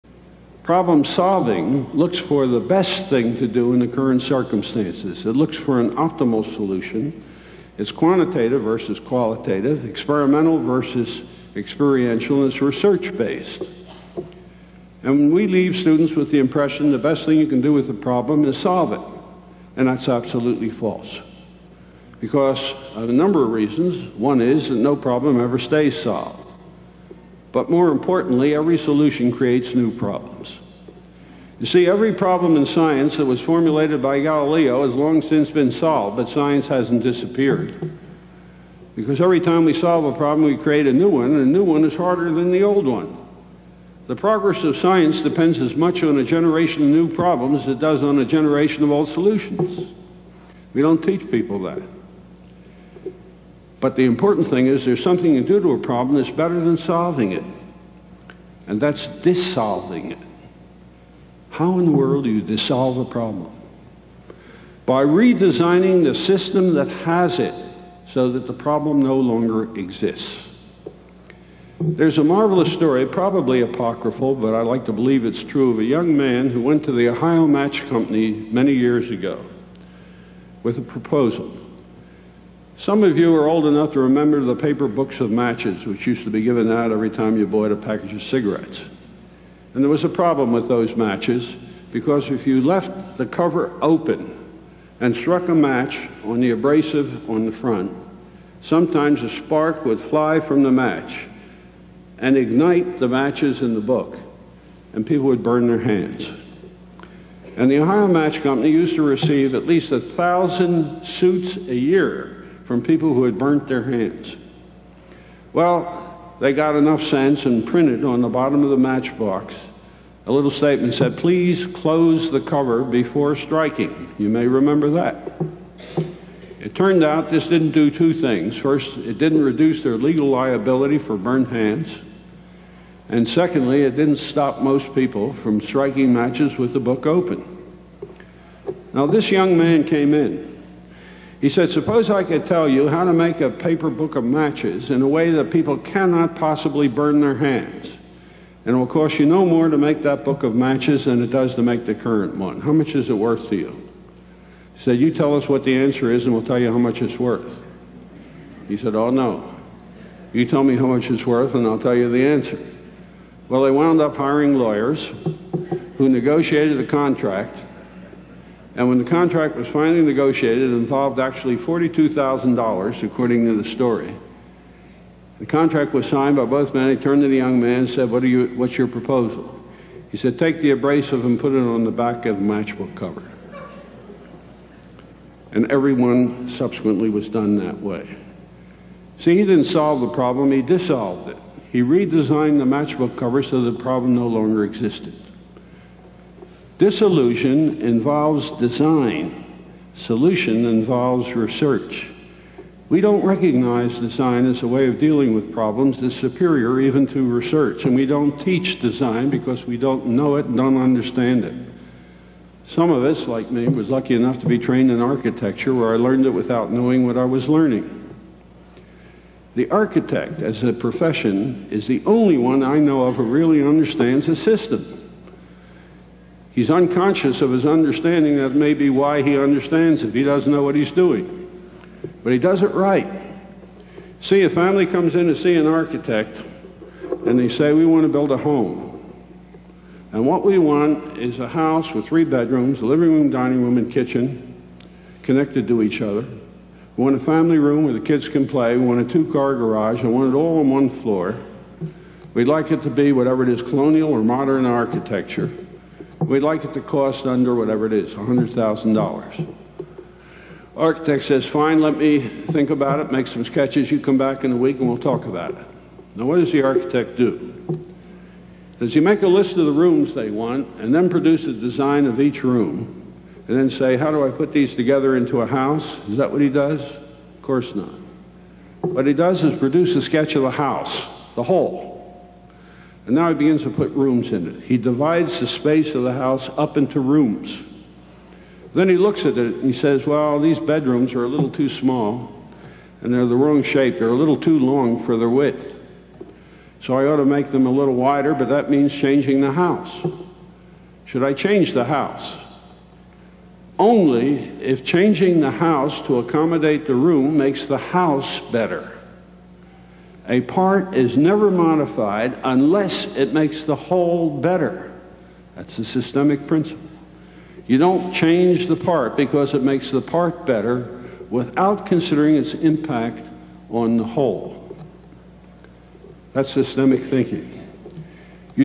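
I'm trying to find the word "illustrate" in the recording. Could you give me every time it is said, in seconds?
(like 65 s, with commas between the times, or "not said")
not said.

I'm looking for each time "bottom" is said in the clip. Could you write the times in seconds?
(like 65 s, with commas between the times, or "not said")
118 s.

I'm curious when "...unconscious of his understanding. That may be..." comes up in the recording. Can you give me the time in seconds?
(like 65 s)
226 s.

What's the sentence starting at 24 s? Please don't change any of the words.
One is that no problem ever stays solved.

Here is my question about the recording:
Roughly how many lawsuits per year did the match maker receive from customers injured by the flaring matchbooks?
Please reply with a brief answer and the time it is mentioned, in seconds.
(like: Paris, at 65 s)
1,000, at 109 s.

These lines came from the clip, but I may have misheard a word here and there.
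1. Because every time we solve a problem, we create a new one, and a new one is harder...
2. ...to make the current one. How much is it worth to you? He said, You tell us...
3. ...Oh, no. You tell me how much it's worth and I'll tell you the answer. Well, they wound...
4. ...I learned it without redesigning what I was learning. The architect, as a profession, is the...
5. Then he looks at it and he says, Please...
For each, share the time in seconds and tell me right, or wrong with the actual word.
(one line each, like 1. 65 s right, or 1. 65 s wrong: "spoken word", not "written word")
1. 38 s right
2. 151 s right
3. 158 s right
4. 215 s wrong: "knowing", not "redesigning"
5. 288 s wrong: "Well", not "Please".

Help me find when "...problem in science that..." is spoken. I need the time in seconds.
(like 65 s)
32 s.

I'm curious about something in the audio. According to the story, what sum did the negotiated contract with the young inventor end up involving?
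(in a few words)
$42,000.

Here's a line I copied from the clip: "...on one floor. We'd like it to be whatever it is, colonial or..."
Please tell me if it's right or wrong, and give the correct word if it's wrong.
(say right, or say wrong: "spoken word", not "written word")
right.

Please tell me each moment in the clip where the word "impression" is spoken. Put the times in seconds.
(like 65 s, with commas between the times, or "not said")
16 s.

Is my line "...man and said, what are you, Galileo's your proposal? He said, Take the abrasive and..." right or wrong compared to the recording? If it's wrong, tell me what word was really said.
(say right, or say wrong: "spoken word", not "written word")
wrong: "What", not "Galileo".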